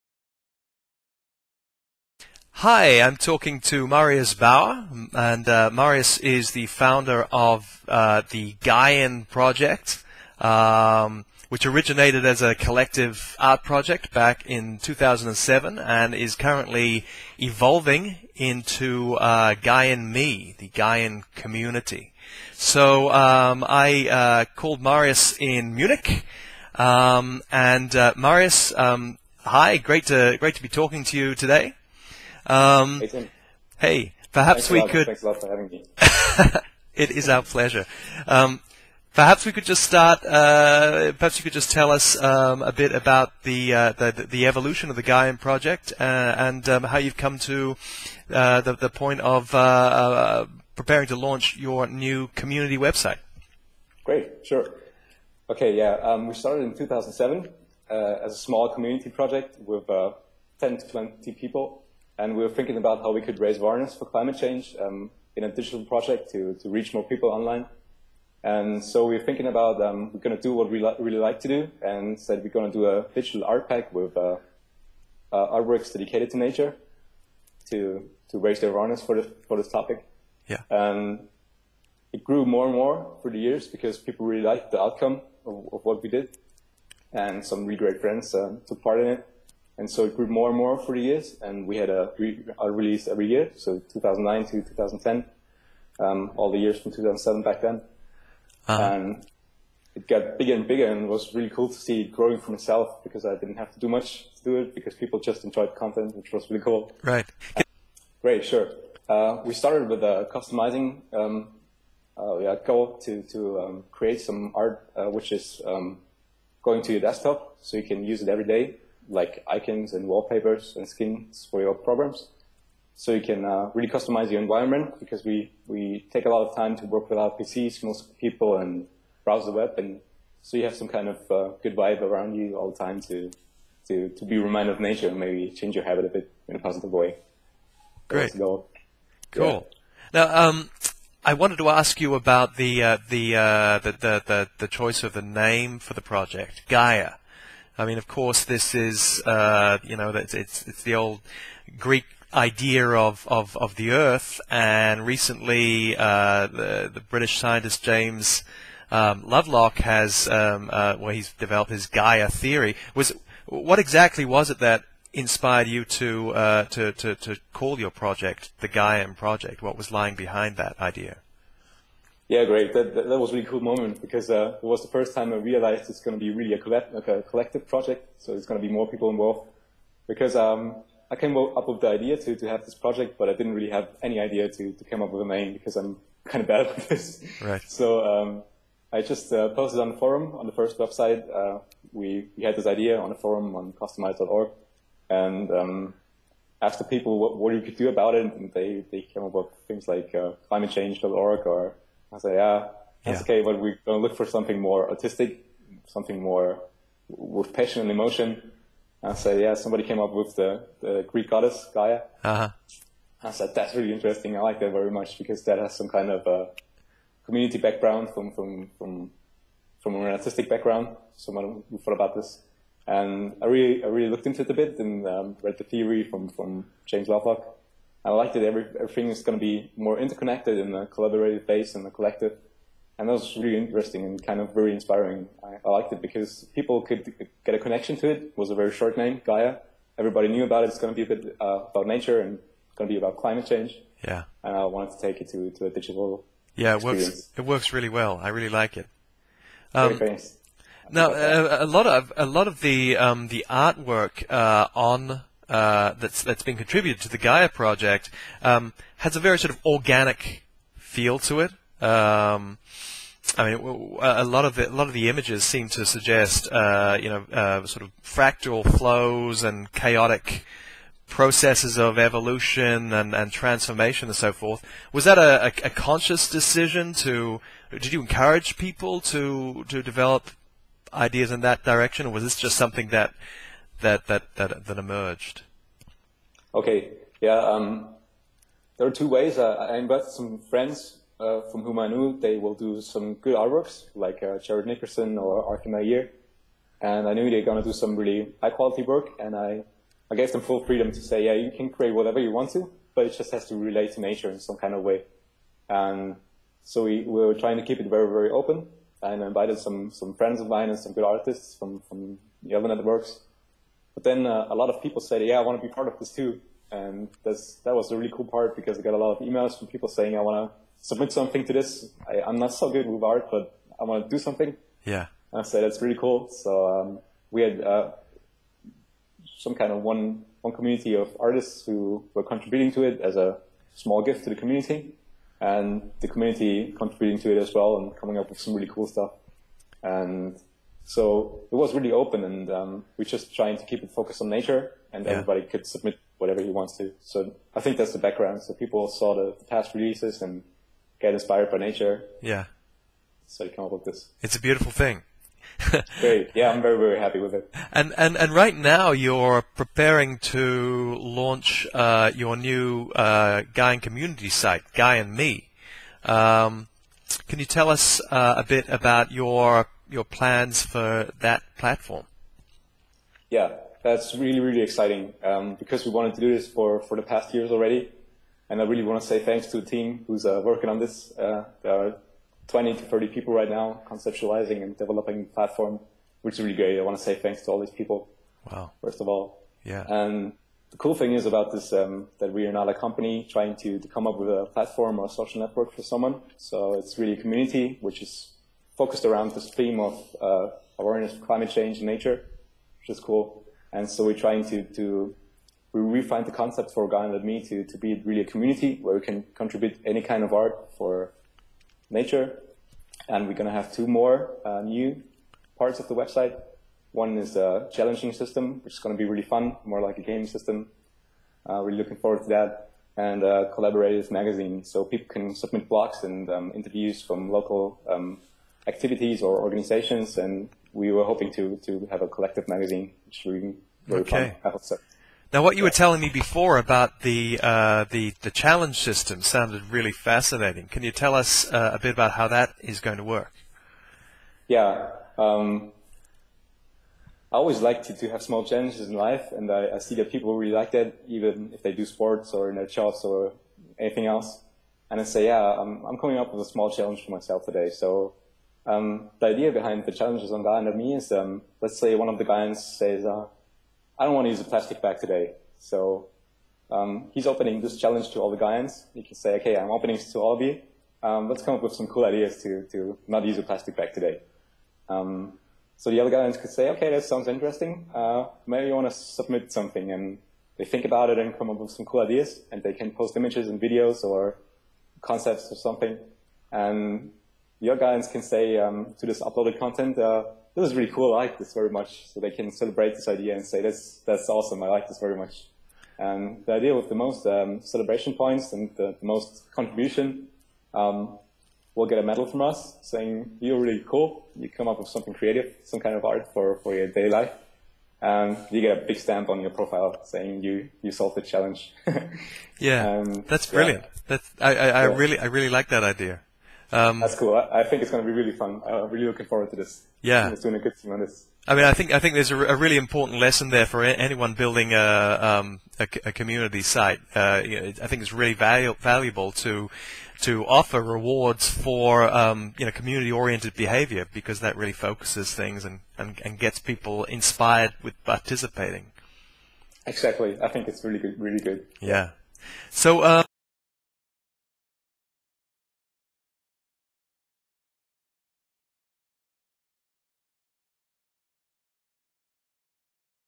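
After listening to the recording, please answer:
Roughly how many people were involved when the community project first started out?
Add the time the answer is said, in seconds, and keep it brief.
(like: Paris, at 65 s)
10 to 20, at 60 s.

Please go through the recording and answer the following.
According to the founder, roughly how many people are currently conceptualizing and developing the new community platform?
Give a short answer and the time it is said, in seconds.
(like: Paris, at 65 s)
20 to 30, at 382 s.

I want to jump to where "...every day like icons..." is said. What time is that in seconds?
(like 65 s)
118 s.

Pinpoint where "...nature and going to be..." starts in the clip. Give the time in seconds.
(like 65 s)
241 s.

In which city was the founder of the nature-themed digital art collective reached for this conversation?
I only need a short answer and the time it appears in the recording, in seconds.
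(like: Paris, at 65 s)
Munich, at 25 s.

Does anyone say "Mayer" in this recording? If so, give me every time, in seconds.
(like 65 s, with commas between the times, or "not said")
295 s.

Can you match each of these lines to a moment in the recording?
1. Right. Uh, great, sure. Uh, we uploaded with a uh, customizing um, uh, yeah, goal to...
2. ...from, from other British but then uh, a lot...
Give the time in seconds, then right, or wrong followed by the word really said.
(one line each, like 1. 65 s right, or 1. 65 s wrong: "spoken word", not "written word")
1. 107 s wrong: "started", not "uploaded"
2. 311 s wrong: "Networks", not "British".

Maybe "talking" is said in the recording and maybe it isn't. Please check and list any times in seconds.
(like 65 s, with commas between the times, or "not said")
3 s, 30 s.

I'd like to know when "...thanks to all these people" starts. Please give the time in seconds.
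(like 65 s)
387 s.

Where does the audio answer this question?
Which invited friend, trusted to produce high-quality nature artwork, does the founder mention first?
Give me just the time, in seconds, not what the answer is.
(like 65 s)
294 s.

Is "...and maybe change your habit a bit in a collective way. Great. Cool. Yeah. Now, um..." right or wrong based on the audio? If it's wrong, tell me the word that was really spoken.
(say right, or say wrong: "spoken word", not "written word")
wrong: "positive", not "collective".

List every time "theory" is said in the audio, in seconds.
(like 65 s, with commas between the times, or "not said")
162 s, 225 s.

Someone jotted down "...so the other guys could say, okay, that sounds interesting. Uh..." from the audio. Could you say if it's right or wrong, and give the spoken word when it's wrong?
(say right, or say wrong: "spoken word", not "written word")
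right.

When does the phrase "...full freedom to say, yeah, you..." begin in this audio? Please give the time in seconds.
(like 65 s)
300 s.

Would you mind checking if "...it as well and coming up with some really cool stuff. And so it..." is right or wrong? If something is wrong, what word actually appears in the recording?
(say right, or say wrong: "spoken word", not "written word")
right.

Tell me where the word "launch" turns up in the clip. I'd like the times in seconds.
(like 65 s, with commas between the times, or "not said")
51 s, 360 s.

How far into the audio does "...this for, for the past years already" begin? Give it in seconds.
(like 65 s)
376 s.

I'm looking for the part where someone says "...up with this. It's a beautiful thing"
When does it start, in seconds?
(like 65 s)
353 s.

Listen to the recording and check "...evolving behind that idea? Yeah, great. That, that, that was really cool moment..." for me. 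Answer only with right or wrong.
wrong.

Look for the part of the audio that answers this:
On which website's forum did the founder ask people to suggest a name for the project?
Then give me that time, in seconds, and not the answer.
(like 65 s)
193 s.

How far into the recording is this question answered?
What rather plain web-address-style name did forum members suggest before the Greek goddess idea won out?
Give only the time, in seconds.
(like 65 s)
200 s.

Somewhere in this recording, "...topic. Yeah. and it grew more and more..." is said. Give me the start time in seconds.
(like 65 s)
79 s.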